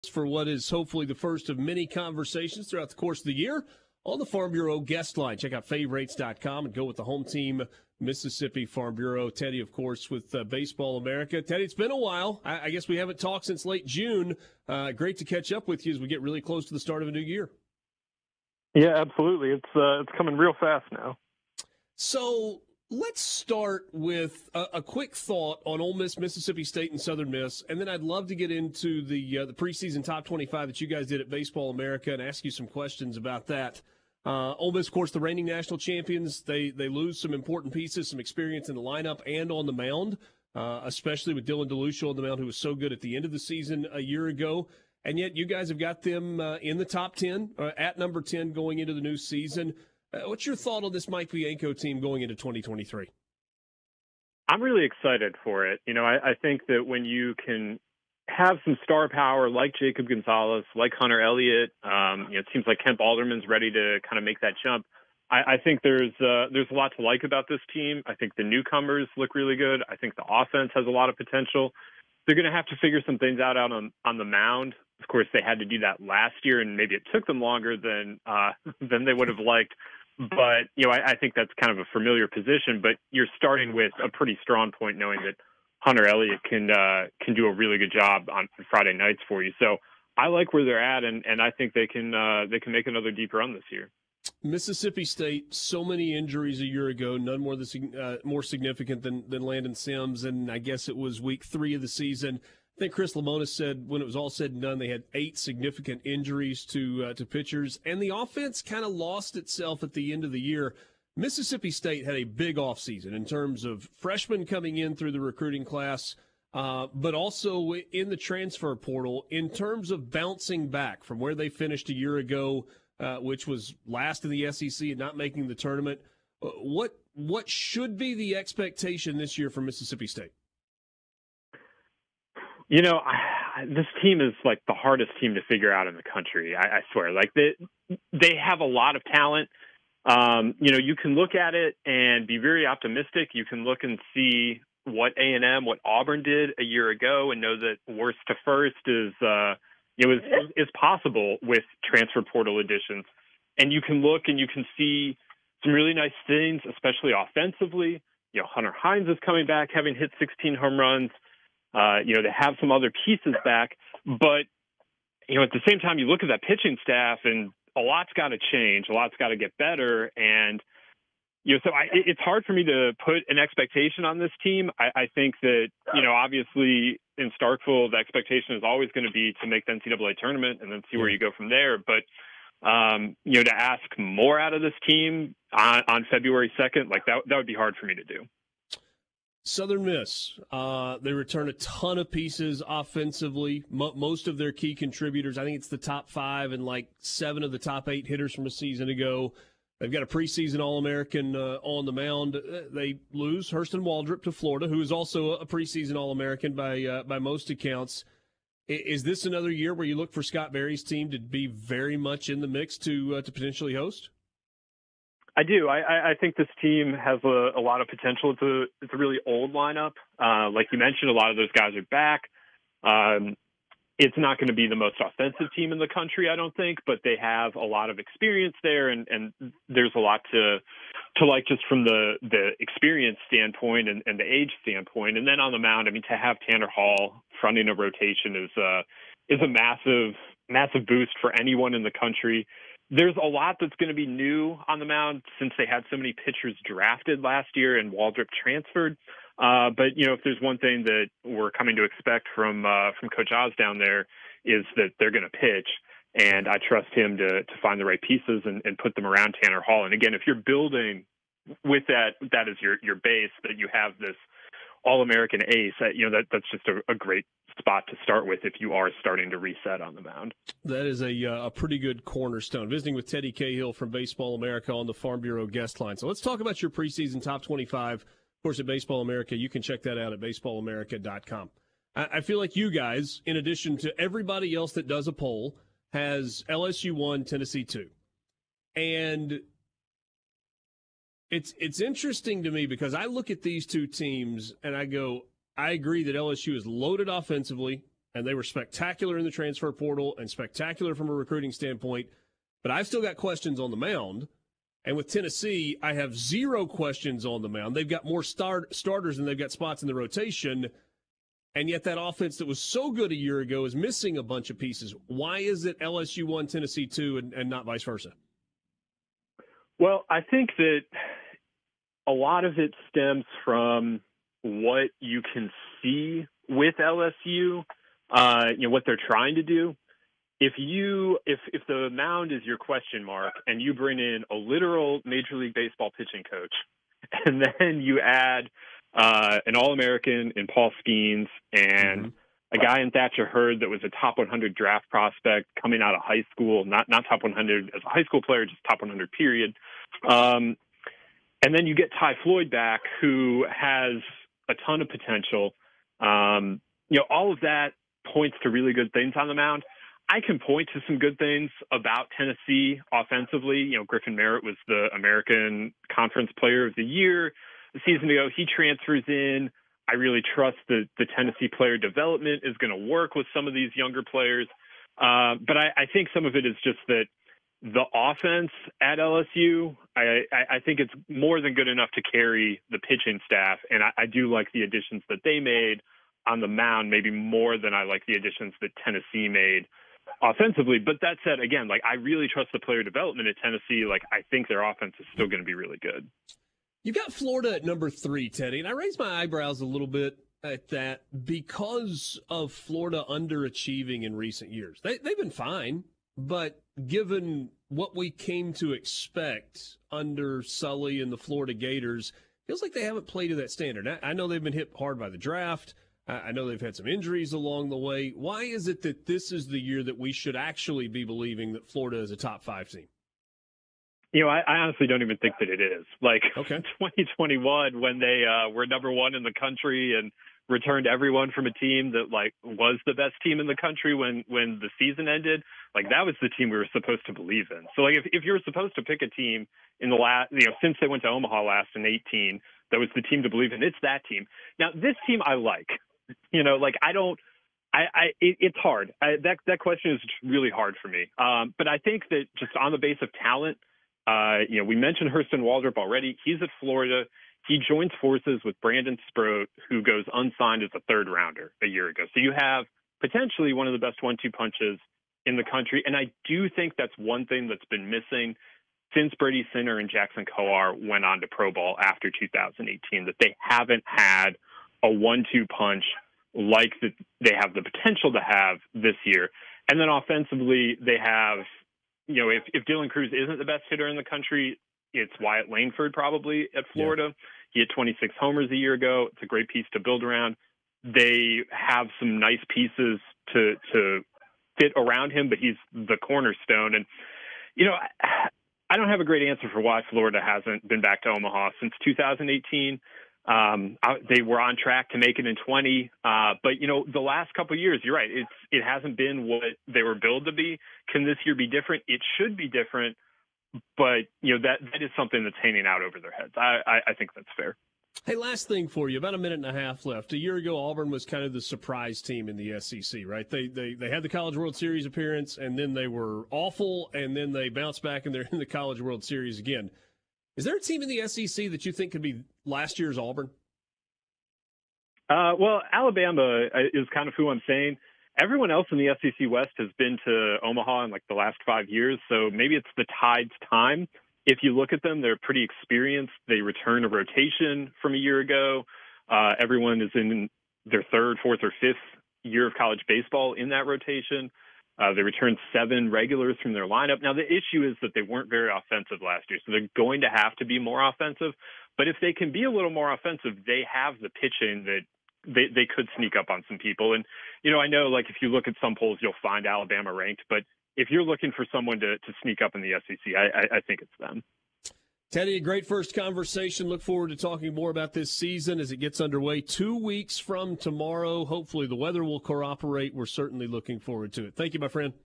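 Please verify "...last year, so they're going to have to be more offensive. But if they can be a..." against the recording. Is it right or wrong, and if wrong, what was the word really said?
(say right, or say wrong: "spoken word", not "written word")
right.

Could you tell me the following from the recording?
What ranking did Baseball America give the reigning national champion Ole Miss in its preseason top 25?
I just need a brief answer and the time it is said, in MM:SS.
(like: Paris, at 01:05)
10, at 00:47.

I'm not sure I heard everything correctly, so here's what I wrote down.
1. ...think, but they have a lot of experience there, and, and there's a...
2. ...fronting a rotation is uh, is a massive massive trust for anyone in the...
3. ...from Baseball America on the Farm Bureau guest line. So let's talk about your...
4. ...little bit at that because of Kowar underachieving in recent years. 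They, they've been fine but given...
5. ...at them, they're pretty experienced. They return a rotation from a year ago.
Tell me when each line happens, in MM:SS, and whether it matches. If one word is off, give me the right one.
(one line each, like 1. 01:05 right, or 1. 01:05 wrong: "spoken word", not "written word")
1. 03:46 right
2. 03:57 wrong: "boost", not "trust"
3. 04:33 right
4. 06:39 wrong: "Florida", not "Kowar"
5. 09:04 right.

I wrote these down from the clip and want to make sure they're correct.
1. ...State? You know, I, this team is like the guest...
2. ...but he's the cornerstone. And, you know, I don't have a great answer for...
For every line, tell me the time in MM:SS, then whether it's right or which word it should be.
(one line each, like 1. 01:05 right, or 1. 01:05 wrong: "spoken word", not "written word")
1. 02:10 wrong: "hardest", not "guest"
2. 08:15 right.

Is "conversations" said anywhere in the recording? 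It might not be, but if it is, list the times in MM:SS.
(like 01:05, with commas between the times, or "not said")
00:01, 09:35.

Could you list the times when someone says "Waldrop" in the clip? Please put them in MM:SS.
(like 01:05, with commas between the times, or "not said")
03:23, 04:07, 07:35.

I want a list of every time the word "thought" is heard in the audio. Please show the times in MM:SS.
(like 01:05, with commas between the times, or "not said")
00:25, 00:50.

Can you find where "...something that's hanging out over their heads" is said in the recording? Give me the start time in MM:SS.
08:34.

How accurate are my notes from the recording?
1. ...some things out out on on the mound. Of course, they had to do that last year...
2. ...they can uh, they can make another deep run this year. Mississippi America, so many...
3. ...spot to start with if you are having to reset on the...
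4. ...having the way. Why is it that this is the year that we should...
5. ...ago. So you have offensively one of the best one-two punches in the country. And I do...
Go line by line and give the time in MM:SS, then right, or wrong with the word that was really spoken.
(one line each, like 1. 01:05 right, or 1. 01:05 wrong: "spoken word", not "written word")
1. 01:13 right
2. 01:31 wrong: "State", not "America"
3. 04:27 wrong: "starting", not "having"
4. 06:57 wrong: "along", not "having"
5. 07:41 wrong: "potentially", not "offensively".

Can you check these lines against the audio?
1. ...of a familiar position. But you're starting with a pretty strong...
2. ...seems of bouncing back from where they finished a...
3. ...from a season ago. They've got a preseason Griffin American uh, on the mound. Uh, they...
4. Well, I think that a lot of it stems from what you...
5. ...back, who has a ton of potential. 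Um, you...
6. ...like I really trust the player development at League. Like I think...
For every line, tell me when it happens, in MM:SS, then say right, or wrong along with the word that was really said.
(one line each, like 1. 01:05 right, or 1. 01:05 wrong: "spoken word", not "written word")
1. 01:21 right
2. 01:59 wrong: "terms", not "seems"
3. 03:18 wrong: "All", not "Griffin"
4. 05:19 right
5. 05:52 right
6. 06:31 wrong: "Tennessee", not "League".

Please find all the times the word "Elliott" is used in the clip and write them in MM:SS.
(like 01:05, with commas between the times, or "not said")
01:01, 01:26.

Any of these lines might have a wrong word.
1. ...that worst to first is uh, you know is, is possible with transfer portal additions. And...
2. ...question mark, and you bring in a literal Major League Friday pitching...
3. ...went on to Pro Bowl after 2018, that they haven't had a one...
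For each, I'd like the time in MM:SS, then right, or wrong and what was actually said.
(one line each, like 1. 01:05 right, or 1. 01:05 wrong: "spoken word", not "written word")
1. 02:27 right
2. 05:32 wrong: "Baseball", not "Friday"
3. 07:50 right.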